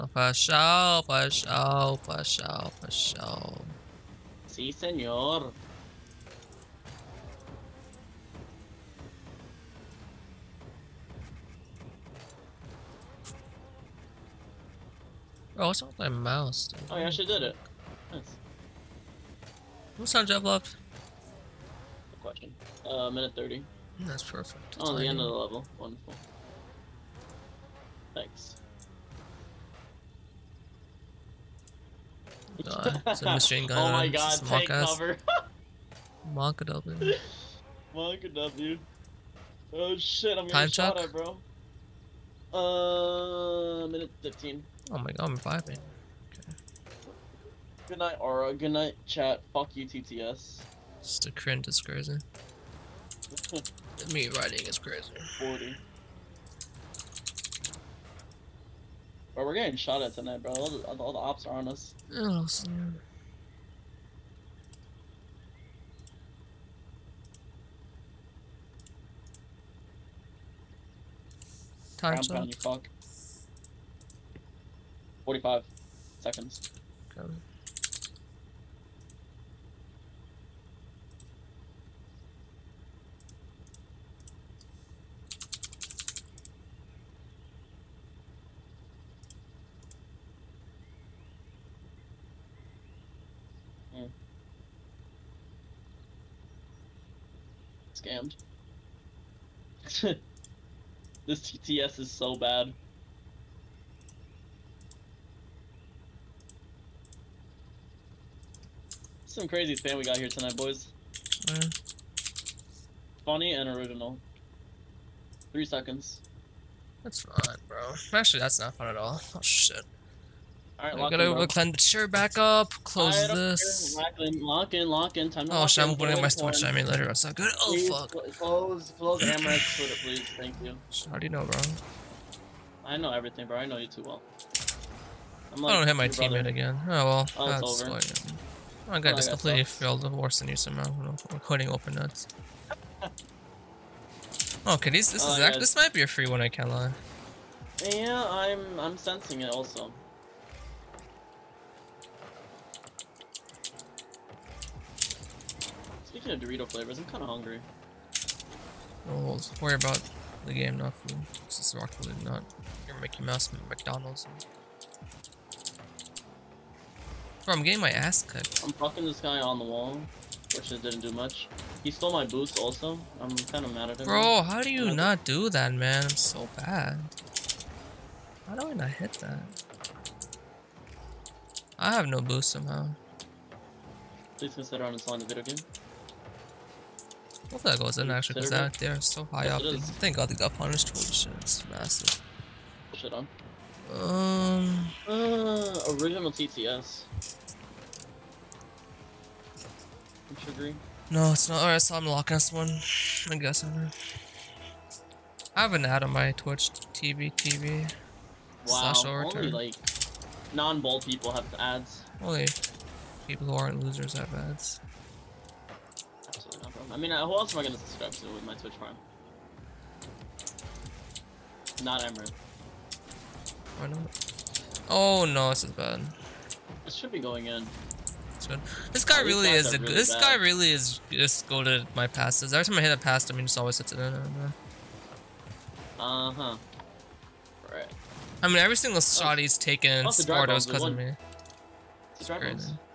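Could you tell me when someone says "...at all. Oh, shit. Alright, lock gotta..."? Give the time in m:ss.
1:58.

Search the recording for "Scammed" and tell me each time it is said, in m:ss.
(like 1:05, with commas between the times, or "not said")
1:37.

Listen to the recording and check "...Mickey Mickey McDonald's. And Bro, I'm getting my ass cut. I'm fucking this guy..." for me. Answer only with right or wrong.
wrong.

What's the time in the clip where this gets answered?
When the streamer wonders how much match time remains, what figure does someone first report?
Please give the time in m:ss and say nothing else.
0:23.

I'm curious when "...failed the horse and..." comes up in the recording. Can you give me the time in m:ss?
2:19.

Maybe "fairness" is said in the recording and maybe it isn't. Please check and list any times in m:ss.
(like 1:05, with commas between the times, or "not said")
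not said.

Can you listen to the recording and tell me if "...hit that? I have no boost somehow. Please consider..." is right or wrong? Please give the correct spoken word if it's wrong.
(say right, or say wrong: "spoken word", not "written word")
right.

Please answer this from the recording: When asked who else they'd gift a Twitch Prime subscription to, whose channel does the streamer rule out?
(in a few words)
Emerald.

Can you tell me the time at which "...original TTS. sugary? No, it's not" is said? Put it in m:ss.
3:16.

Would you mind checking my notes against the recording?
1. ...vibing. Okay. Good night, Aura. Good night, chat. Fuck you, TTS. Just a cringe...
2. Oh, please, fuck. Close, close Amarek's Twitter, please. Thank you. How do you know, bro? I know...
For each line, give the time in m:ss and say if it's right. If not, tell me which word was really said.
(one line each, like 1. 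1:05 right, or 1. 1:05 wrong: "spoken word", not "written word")
1. 0:45 right
2. 2:07 right.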